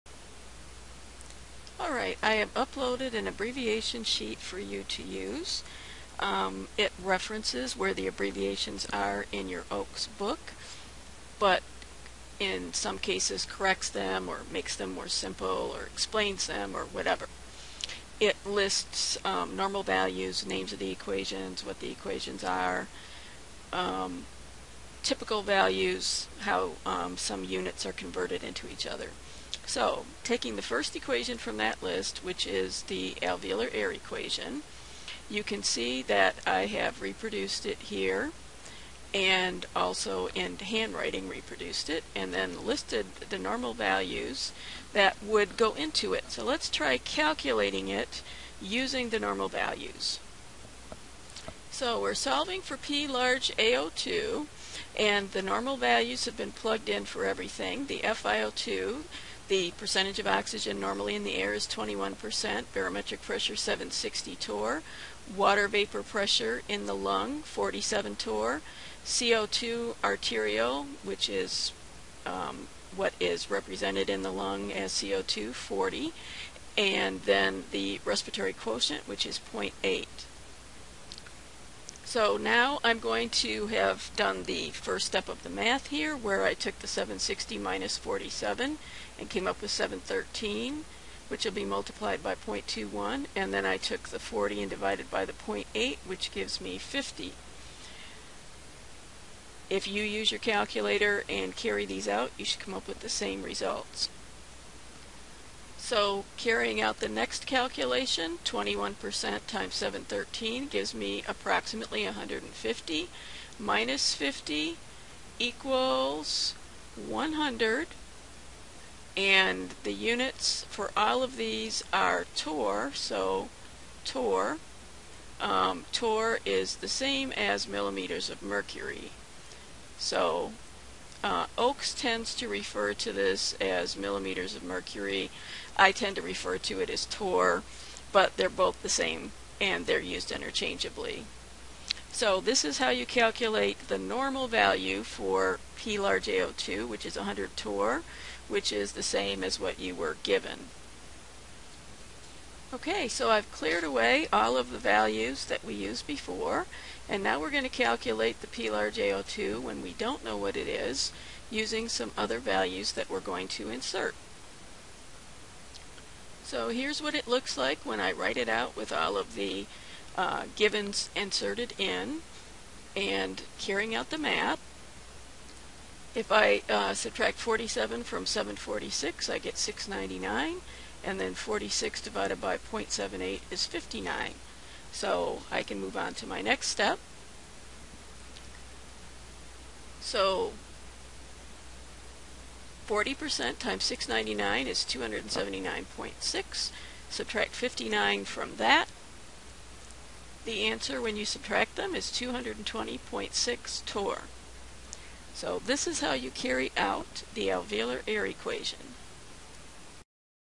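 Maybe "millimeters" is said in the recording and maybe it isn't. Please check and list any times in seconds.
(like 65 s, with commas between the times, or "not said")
127 s, 133 s.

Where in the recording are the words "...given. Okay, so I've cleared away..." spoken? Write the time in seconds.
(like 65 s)
150 s.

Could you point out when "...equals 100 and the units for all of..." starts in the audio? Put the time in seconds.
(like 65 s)
115 s.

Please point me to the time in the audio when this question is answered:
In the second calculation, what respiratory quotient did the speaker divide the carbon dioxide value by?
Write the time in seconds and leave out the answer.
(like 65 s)
182 s.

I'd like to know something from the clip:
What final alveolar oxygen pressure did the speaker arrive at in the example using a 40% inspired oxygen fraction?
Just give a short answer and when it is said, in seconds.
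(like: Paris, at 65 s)
220.6 torr, at 202 s.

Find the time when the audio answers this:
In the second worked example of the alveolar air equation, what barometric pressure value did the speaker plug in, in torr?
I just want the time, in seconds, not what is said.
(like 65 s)
178 s.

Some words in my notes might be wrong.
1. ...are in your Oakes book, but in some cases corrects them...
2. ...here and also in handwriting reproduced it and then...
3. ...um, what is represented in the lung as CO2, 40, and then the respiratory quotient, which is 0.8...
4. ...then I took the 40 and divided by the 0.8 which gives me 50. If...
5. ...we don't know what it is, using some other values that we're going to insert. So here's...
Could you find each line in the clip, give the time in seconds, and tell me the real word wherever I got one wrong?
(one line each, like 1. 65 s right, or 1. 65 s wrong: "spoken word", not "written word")
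1. 8 s right
2. 37 s right
3. 72 s right
4. 93 s right
5. 159 s right.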